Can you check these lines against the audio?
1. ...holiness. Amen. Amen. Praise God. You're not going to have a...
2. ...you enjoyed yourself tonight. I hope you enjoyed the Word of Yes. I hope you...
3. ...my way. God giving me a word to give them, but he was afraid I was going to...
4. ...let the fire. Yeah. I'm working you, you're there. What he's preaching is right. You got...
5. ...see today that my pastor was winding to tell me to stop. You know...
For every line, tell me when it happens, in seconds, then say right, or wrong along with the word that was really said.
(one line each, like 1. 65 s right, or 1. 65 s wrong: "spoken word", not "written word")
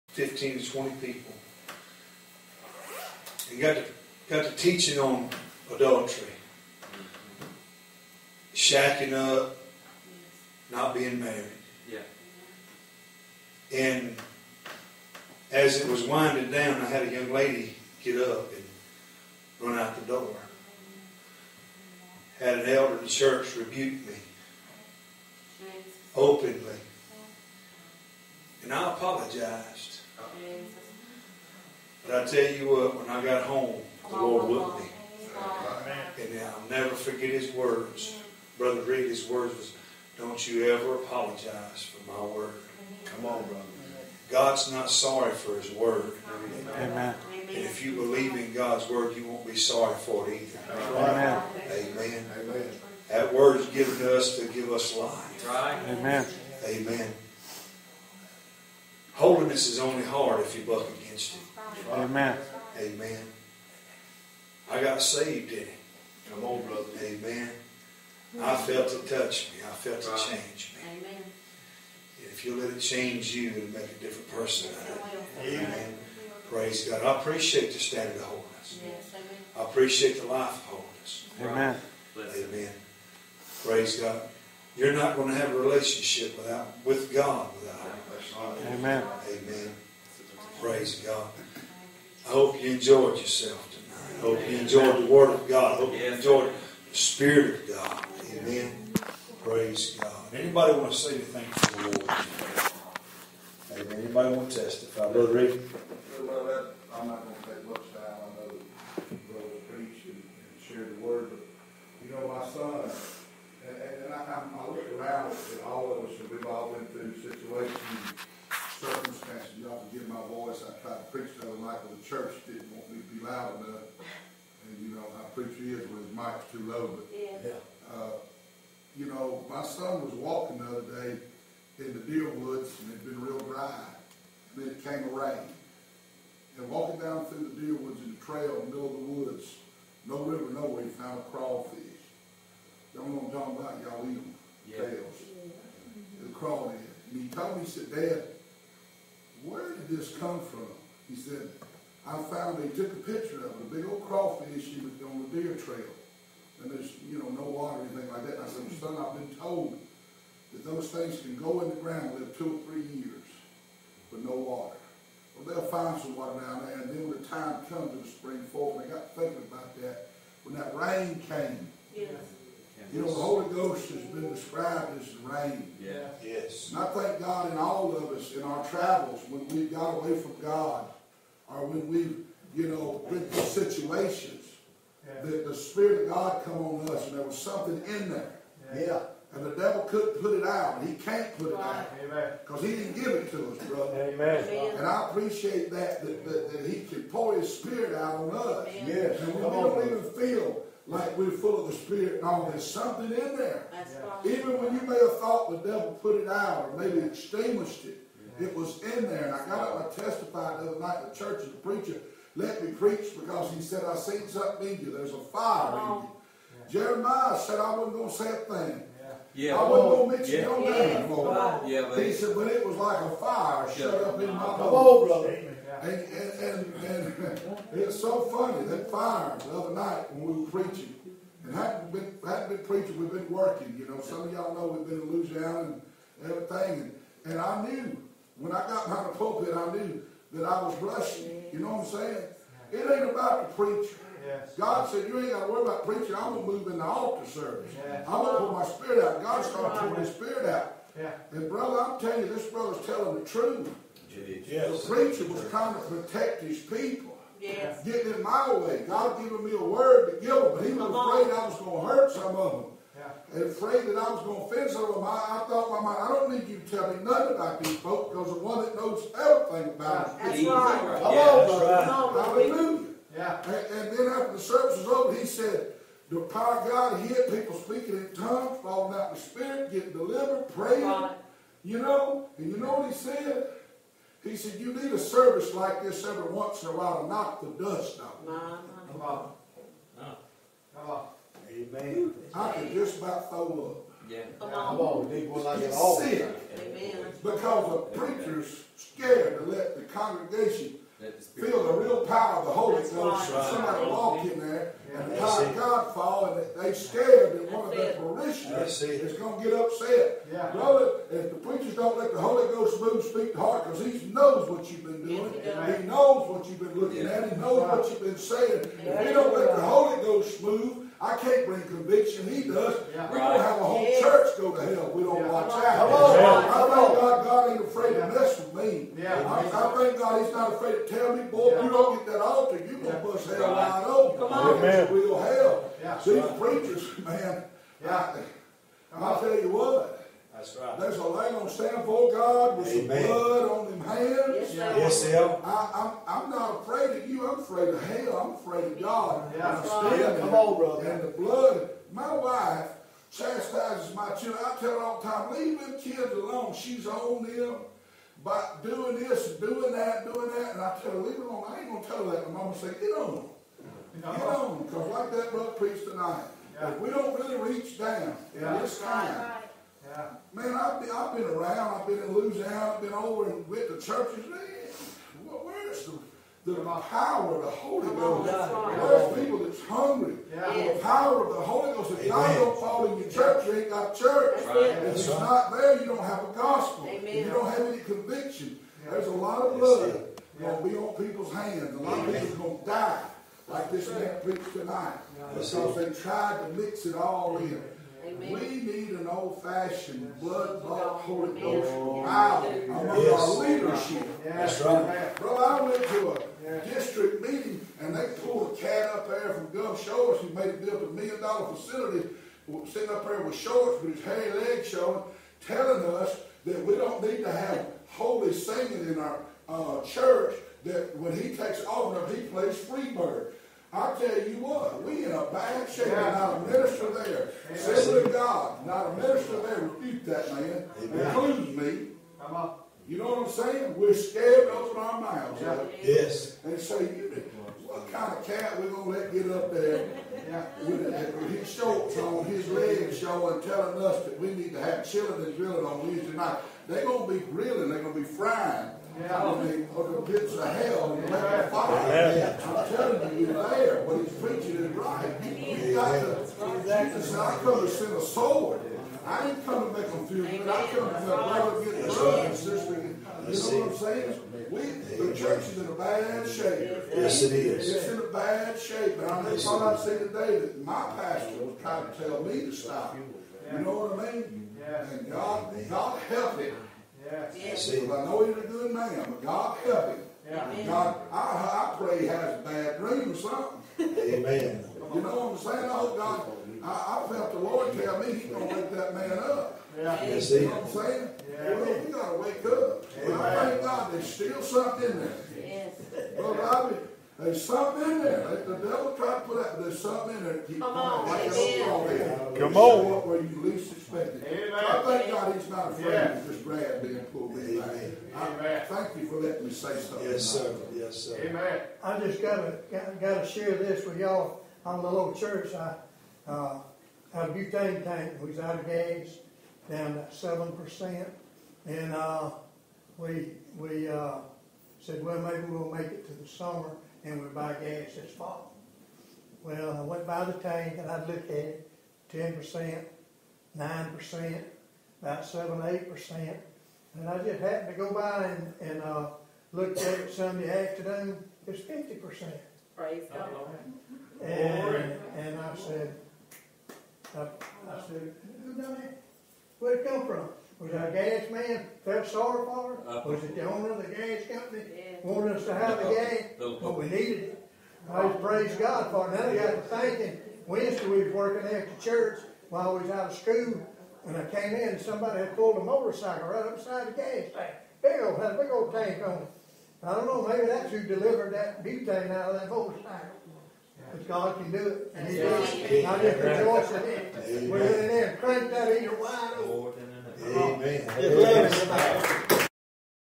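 1. 80 s right
2. 92 s wrong: "God", not "Yes"
3. 258 s right
4. 451 s wrong: "telling", not "working"
5. 469 s wrong: "trying", not "winding".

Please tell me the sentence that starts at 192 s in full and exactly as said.
Because he didn't give it to us, brother.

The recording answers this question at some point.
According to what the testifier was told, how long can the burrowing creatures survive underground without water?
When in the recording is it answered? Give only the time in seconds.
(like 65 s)
162 s.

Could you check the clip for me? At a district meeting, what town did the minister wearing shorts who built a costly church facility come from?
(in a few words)
Gulf Shores.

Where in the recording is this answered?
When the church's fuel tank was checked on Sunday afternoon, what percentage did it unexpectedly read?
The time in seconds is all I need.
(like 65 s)
541 s.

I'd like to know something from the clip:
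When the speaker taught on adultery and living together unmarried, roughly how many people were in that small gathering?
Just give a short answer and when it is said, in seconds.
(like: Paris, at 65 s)
15 to 20, at 0 s.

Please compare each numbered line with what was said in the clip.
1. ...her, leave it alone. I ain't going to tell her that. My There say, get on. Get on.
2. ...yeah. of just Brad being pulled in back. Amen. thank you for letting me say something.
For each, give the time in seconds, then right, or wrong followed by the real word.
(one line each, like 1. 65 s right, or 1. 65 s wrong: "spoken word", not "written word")
1. 360 s wrong: "Mama", not "There"
2. 505 s right.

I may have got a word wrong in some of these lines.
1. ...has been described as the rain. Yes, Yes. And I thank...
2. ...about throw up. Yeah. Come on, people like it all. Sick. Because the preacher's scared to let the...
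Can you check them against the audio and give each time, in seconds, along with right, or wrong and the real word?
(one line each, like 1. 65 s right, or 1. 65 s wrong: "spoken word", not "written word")
1. 173 s right
2. 292 s right.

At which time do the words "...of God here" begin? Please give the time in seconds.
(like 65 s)
276 s.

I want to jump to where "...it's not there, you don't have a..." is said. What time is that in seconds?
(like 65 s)
384 s.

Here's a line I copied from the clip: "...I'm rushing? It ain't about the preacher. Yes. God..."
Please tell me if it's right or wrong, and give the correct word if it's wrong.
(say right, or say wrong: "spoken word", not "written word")
wrong: "saying", not "rushing".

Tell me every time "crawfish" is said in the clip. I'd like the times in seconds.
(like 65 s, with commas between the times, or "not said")
141 s, 146 s, 154 s.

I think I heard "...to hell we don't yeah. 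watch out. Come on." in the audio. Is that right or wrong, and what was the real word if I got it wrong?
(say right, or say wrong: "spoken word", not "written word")
right.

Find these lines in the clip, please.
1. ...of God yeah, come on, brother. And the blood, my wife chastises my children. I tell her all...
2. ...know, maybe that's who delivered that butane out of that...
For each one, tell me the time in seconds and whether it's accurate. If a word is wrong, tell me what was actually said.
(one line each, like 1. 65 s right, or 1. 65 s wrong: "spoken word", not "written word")
1. 348 s right
2. 570 s right.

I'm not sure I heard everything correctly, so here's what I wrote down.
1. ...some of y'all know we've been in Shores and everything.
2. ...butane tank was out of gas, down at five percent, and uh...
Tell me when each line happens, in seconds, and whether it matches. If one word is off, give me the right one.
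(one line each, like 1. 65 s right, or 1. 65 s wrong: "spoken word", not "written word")
1. 234 s wrong: "Louisiana", not "Shores"
2. 517 s wrong: "seven", not "five".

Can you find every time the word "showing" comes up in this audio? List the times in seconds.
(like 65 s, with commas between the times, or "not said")
414 s, 442 s.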